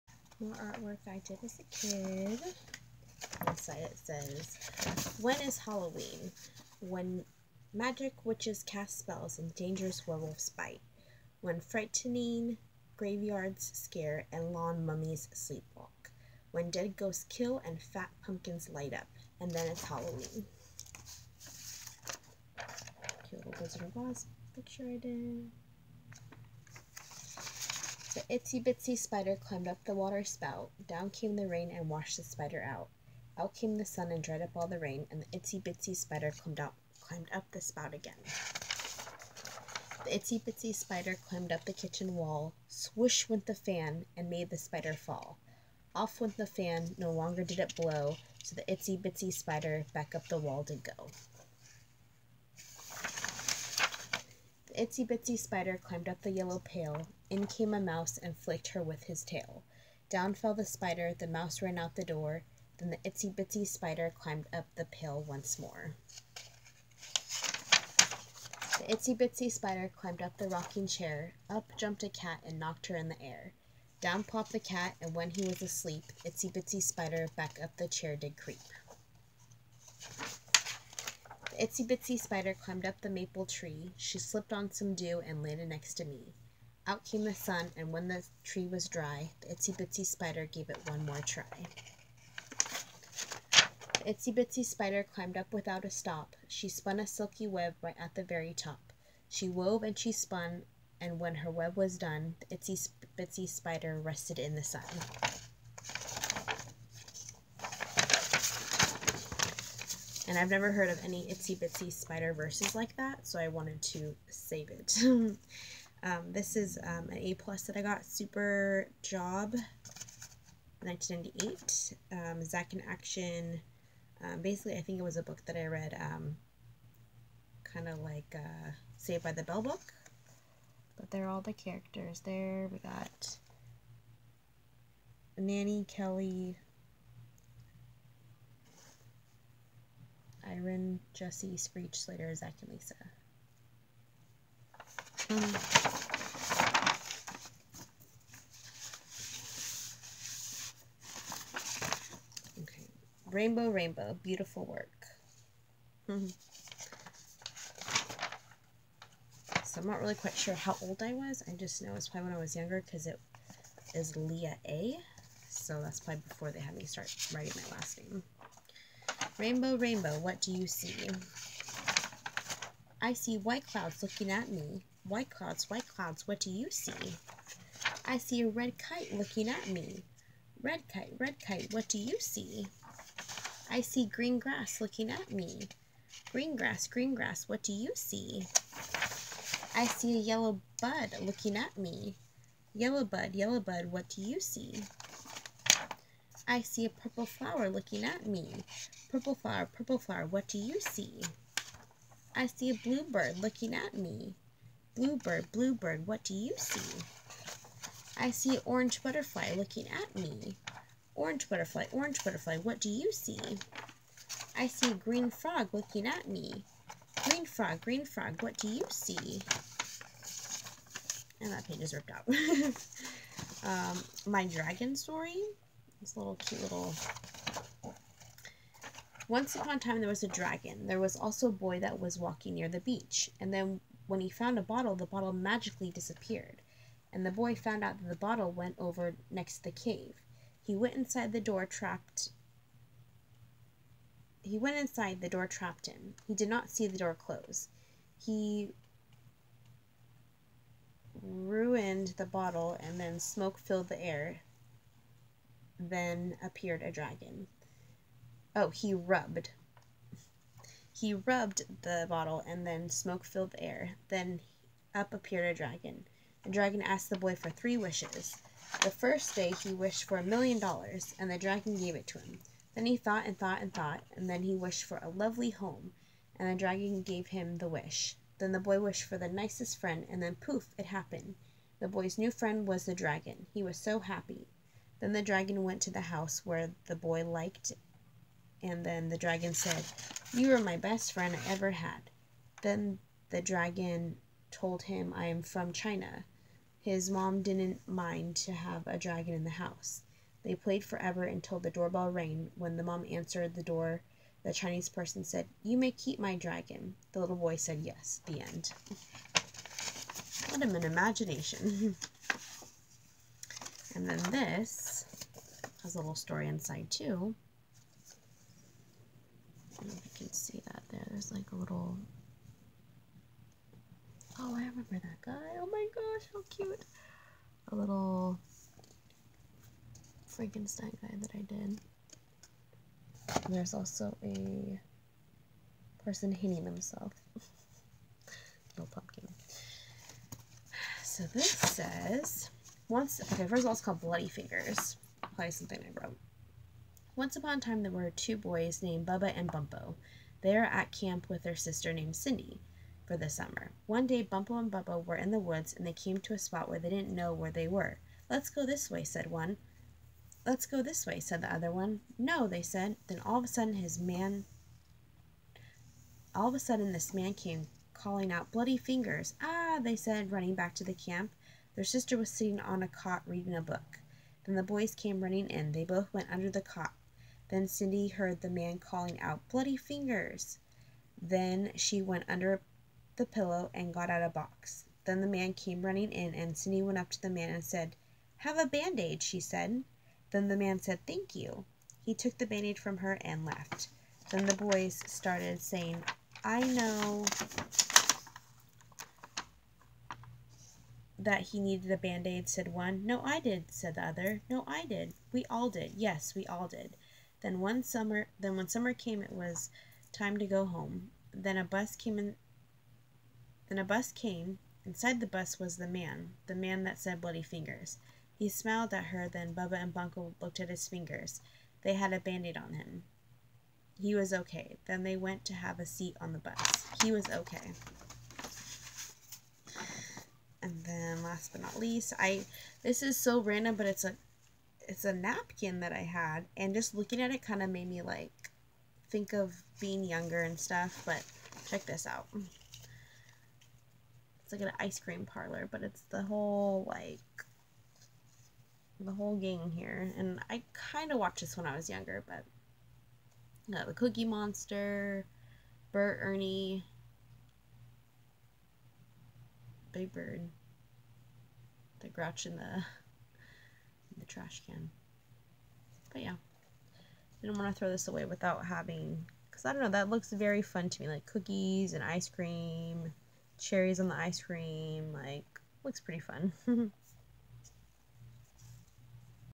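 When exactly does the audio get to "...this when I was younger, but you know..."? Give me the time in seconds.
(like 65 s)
451 s.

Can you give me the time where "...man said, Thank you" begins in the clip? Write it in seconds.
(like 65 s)
390 s.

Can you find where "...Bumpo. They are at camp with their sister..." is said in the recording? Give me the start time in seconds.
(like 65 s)
349 s.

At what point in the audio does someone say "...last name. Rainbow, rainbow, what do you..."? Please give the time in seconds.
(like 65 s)
167 s.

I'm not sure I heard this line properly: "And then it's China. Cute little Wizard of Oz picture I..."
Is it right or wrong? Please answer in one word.
wrong.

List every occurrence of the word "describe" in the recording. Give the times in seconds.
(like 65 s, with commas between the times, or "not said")
not said.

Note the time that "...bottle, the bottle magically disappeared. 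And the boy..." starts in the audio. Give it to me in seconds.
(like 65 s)
234 s.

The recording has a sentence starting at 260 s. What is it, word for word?
He rubbed the bottle and then smoke filled the air.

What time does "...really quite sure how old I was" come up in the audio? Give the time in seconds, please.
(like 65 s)
160 s.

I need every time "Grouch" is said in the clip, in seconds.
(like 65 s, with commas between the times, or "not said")
462 s.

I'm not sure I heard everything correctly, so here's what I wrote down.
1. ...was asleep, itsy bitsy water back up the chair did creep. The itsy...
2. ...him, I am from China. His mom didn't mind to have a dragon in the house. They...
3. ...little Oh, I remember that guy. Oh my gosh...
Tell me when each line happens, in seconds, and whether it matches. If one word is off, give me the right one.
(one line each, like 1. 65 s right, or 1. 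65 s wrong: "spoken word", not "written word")
1. 75 s wrong: "spider", not "water"
2. 294 s right
3. 321 s right.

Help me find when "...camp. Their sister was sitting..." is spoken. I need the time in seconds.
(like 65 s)
370 s.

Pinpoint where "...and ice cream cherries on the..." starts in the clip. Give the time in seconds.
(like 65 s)
471 s.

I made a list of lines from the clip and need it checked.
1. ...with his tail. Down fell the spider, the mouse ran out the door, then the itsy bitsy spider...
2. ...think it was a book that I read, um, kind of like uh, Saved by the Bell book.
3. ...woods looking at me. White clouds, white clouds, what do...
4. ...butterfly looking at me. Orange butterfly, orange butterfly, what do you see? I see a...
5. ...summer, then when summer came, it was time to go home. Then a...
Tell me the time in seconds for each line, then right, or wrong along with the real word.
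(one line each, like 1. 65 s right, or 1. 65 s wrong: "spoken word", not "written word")
1. 58 s right
2. 124 s right
3. 173 s wrong: "clouds", not "woods"
4. 209 s right
5. 407 s right.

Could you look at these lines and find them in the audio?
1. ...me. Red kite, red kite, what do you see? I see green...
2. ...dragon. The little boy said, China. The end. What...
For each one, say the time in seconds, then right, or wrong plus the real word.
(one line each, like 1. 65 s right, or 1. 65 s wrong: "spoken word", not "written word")
1. 179 s right
2. 306 s wrong: "Yes", not "China".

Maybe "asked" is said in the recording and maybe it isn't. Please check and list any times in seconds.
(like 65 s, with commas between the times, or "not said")
266 s.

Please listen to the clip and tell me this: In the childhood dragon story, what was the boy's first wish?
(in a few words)
a million dollars.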